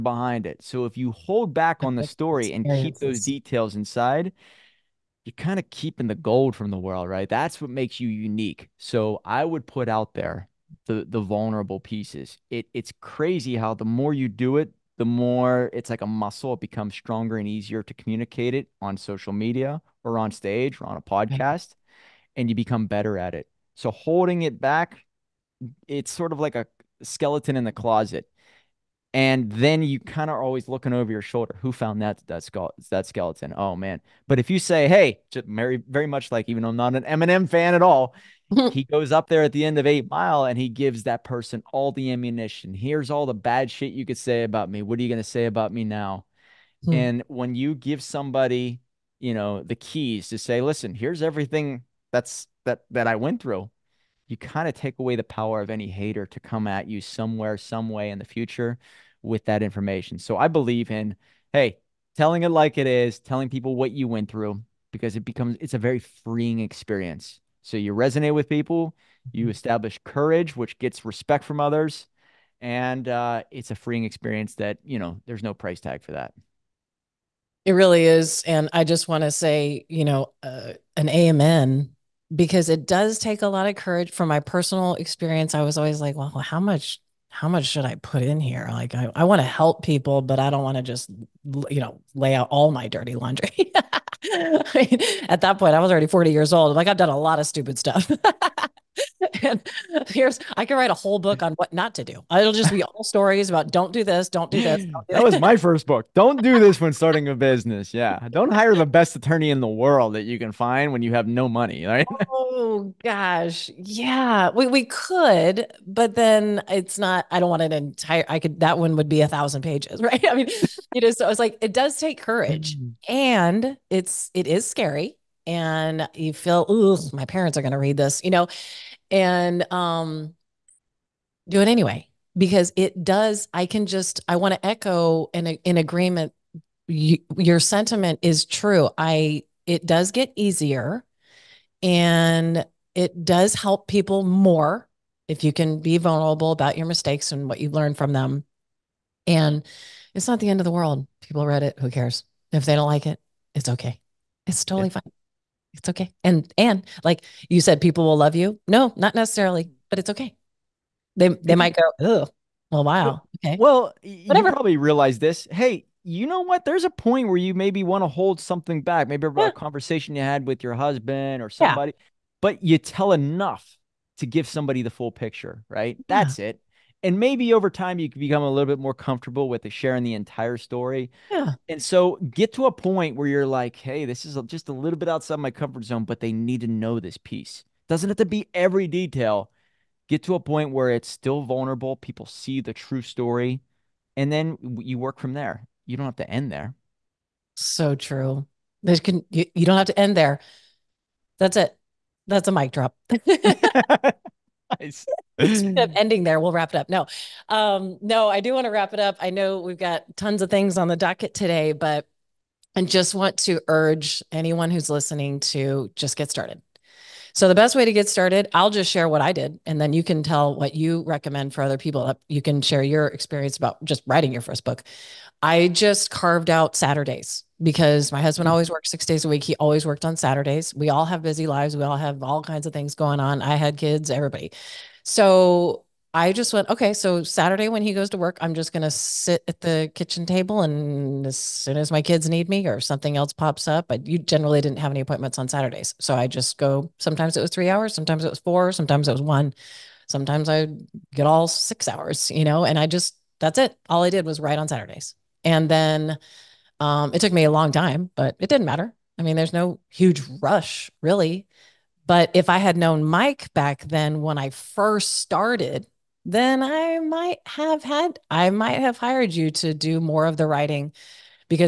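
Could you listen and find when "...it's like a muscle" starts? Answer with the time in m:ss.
0:15.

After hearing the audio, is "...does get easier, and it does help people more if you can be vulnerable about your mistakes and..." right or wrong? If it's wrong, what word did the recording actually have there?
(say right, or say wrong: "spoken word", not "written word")
right.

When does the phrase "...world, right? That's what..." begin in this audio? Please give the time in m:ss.
0:06.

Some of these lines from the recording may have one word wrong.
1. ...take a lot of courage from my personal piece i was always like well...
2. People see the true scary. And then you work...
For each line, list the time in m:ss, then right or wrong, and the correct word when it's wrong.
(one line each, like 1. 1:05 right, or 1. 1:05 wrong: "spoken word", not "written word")
1. 1:23 wrong: "experience", not "piece"
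2. 3:11 wrong: "story", not "scary".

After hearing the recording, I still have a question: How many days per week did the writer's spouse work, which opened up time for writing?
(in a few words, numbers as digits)
6 days.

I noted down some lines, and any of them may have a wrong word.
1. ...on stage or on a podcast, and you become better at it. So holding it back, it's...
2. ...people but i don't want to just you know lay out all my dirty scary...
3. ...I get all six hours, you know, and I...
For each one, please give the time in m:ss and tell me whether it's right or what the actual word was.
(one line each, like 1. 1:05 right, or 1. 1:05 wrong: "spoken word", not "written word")
1. 0:20 right
2. 1:29 wrong: "laundry", not "scary"
3. 4:10 right.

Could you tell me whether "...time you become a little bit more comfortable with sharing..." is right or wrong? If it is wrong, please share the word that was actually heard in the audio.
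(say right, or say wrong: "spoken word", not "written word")
right.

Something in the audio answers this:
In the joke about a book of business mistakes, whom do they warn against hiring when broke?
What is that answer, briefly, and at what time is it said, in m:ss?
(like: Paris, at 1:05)
The best attorney, at 1:48.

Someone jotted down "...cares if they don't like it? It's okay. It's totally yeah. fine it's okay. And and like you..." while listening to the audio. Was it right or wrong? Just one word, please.
right.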